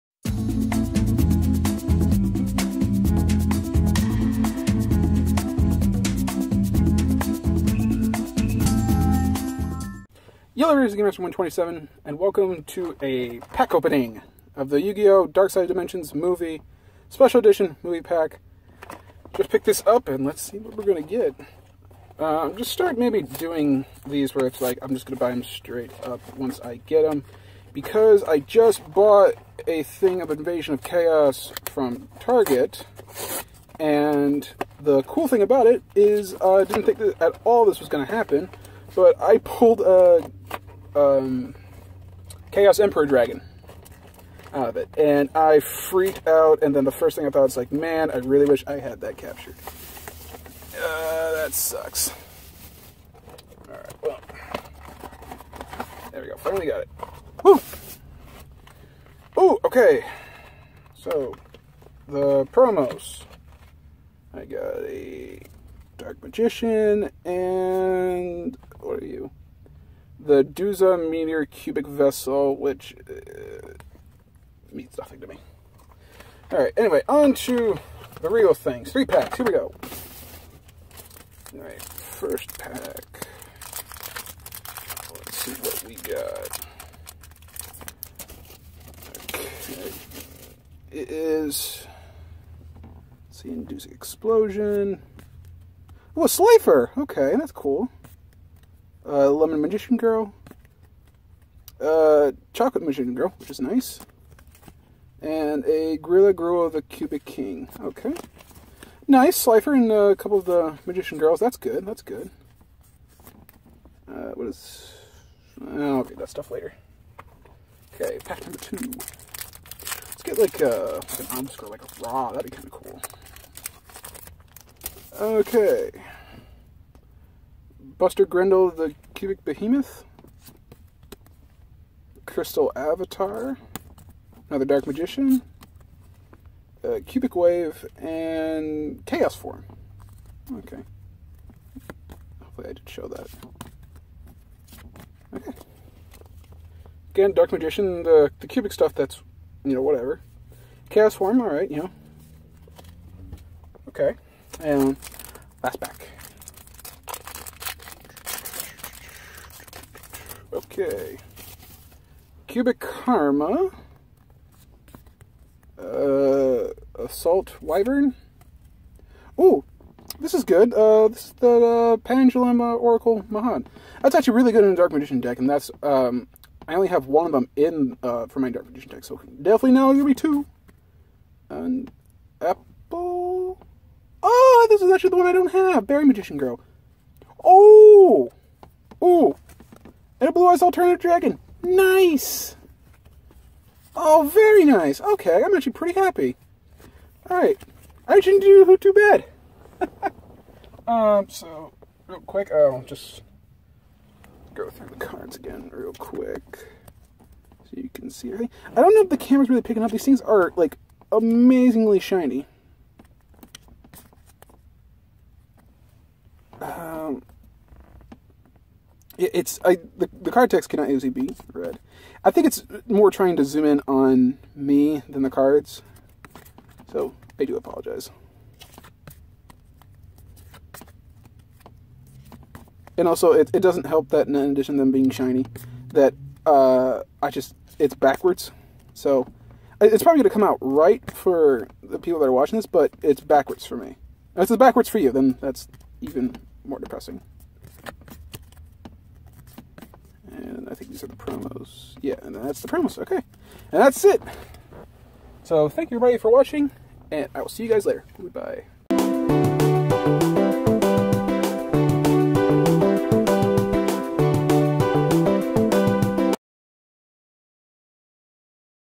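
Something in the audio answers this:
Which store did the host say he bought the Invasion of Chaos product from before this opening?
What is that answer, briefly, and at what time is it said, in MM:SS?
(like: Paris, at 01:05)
Target, at 00:32.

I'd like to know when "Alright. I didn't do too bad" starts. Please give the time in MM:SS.
03:17.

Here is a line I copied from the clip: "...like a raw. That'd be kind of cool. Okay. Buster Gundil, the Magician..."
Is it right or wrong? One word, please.
wrong.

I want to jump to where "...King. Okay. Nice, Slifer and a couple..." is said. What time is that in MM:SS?
01:47.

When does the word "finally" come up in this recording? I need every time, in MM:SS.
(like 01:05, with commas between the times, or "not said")
00:56.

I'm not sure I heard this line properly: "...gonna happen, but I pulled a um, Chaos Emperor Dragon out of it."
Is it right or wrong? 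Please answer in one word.
right.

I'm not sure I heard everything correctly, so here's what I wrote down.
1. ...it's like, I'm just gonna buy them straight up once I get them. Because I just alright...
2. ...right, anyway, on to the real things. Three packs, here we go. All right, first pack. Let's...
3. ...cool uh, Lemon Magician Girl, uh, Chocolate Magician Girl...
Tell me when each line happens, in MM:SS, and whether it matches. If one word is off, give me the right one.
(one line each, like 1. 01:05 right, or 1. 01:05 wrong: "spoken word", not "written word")
1. 00:24 wrong: "bought", not "alright"
2. 01:16 right
3. 01:37 right.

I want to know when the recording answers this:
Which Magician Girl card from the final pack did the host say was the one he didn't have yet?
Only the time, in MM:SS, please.
03:05.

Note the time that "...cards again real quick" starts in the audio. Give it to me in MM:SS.
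03:24.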